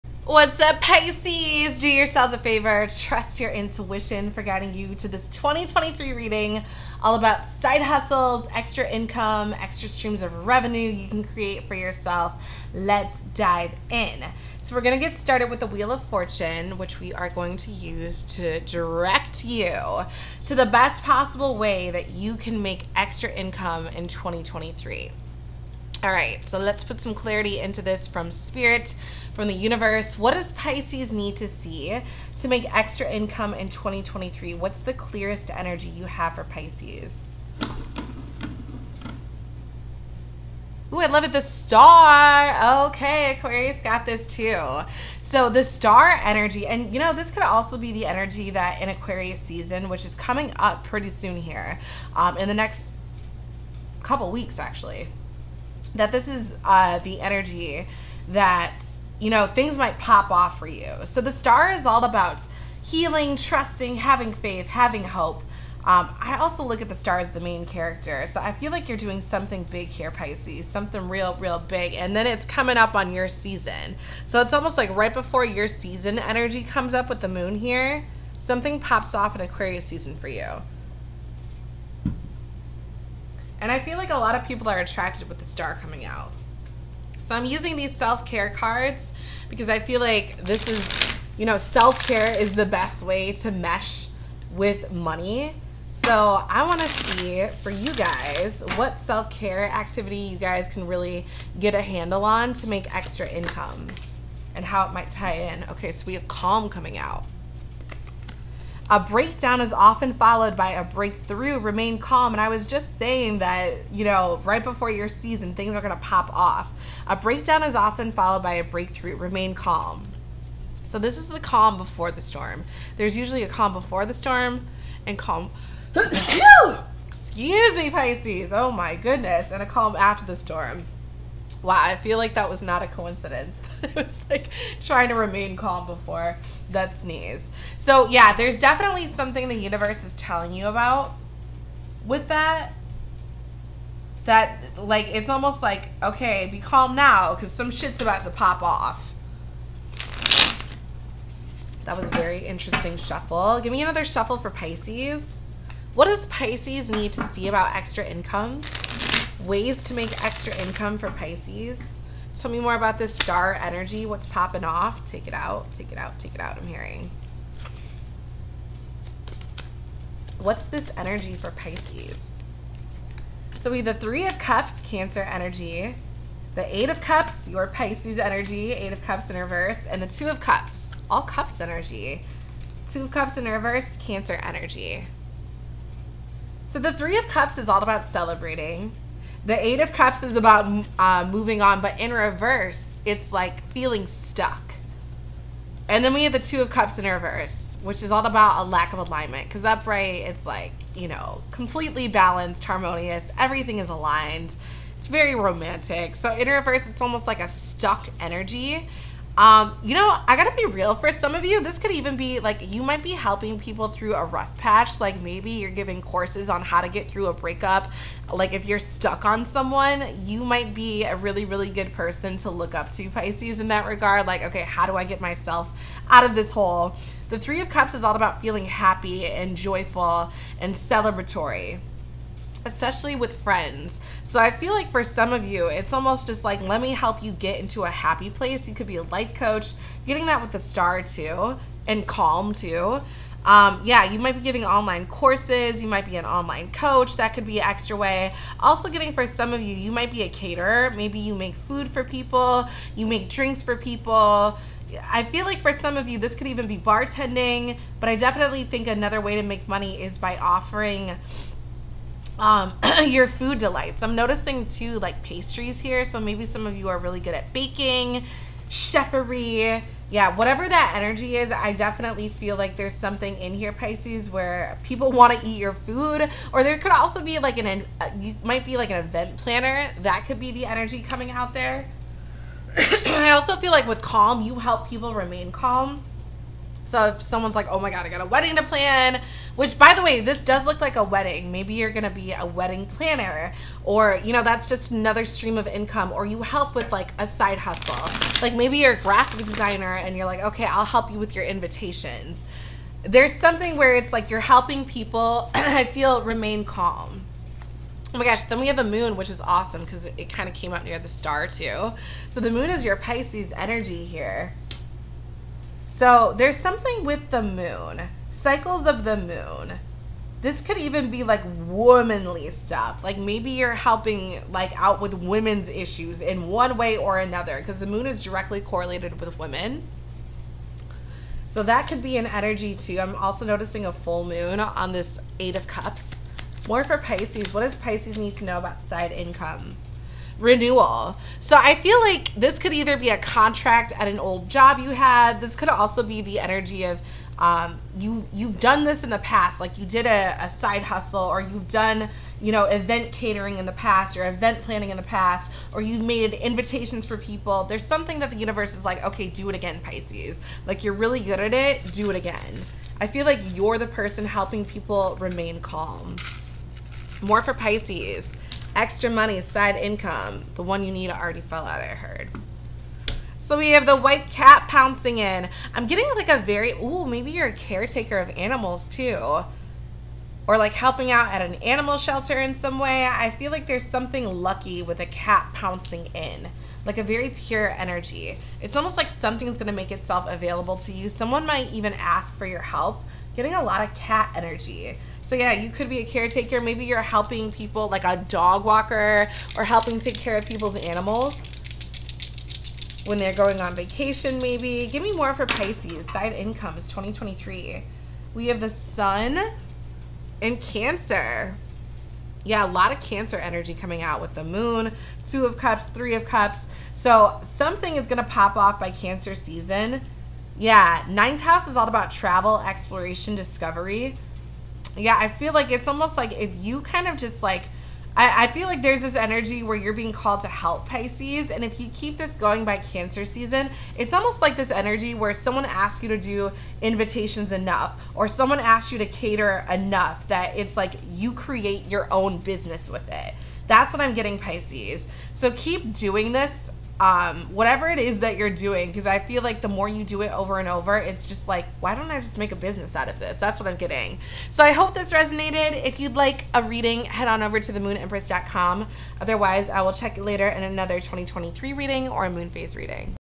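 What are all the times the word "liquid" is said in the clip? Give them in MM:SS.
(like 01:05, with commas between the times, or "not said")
not said.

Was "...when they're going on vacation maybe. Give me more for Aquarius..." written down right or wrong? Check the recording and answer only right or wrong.
wrong.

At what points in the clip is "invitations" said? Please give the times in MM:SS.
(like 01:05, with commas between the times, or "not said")
05:01, 05:56, 07:16.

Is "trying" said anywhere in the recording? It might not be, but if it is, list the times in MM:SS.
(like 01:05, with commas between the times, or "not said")
02:14.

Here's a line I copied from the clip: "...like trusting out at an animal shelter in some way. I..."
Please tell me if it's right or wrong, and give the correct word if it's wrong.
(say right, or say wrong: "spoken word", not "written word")
wrong: "helping", not "trusting".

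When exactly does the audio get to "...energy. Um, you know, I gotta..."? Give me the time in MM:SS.
03:28.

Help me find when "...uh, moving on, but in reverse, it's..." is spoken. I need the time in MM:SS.
03:10.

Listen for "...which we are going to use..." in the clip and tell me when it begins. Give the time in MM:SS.
00:16.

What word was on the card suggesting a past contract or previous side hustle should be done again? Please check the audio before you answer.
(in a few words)
Renewal.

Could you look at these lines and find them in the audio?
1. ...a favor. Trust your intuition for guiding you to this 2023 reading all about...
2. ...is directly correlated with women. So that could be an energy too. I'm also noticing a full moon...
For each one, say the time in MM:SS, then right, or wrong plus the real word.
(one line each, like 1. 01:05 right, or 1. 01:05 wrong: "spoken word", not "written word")
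1. 00:02 right
2. 05:28 right.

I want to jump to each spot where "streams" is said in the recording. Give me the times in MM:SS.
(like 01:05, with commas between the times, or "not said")
00:09, 04:55.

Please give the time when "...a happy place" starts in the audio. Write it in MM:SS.
03:57.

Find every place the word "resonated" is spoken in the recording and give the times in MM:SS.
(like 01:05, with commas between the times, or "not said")
07:35.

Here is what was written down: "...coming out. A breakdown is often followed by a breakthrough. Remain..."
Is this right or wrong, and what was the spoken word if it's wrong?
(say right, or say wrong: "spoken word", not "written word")
right.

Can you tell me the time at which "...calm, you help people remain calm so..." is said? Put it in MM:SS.
04:44.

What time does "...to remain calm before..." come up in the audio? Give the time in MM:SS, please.
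02:15.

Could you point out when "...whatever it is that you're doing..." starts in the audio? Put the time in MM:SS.
07:27.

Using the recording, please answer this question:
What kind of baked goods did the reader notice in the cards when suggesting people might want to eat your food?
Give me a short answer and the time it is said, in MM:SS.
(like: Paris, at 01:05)
Pastries, at 04:25.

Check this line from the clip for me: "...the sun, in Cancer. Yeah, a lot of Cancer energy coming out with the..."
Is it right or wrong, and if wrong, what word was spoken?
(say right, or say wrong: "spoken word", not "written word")
right.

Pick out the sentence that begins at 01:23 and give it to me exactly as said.
And I feel like a lot of people are attracted with the star coming out.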